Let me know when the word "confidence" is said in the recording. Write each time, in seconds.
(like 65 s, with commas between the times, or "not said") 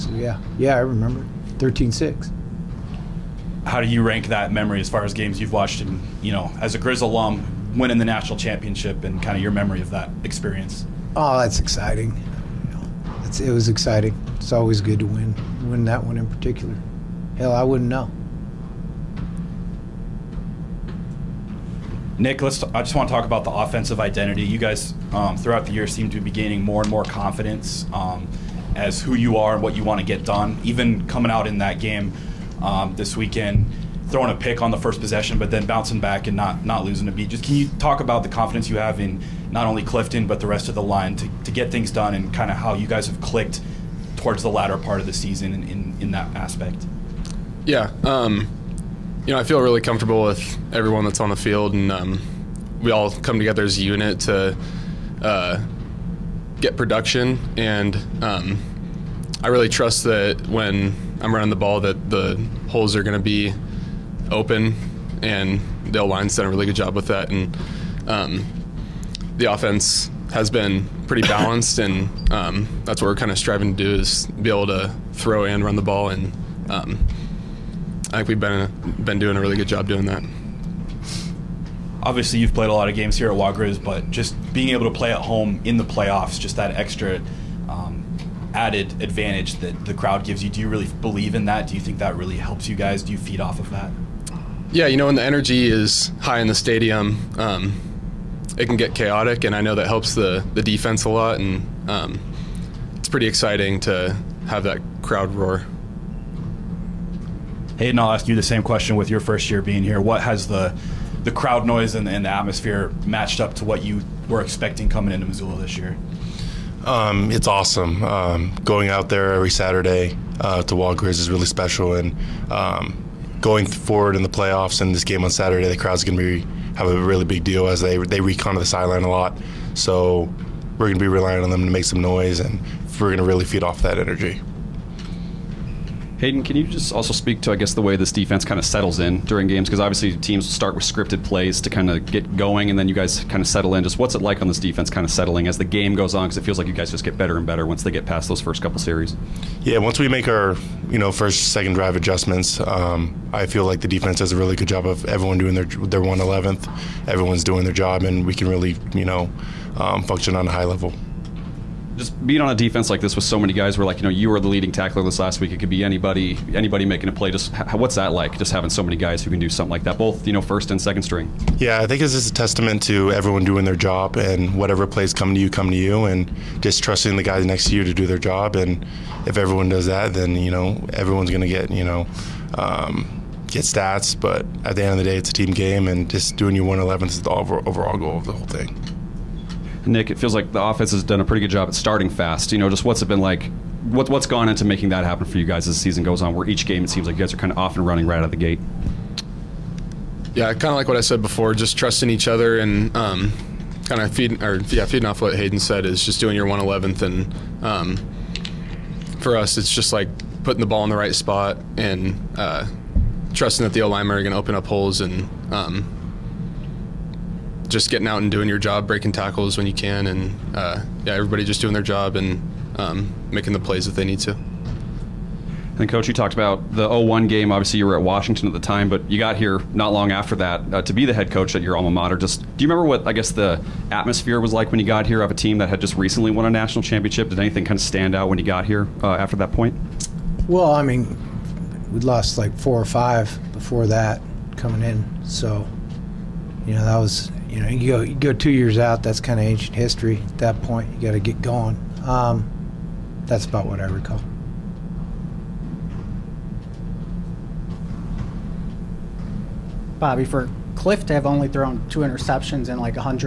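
27 s, 38 s.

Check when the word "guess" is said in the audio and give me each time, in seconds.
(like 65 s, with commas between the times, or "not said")
137 s, 233 s.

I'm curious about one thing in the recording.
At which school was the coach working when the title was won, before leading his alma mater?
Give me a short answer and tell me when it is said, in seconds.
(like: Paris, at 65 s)
Washington, at 228 s.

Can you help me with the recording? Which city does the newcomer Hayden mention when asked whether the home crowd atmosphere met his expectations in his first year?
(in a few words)
Missoula.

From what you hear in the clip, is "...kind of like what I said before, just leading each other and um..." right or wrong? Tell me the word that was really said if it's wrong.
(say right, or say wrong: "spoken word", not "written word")
wrong: "trusting", not "leading".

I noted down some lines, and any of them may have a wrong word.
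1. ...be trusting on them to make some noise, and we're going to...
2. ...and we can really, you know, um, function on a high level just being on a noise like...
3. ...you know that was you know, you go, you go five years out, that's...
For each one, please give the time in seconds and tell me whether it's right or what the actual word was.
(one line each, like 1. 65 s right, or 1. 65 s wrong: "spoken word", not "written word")
1. 130 s wrong: "relying", not "trusting"
2. 158 s wrong: "defense", not "noise"
3. 246 s wrong: "two", not "five".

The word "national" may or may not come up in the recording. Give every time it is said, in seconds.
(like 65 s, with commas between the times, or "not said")
8 s, 236 s.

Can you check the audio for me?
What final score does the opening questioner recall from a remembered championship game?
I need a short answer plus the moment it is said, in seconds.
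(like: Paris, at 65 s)
13-6, at 1 s.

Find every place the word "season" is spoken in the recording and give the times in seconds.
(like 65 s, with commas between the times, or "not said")
45 s, 195 s.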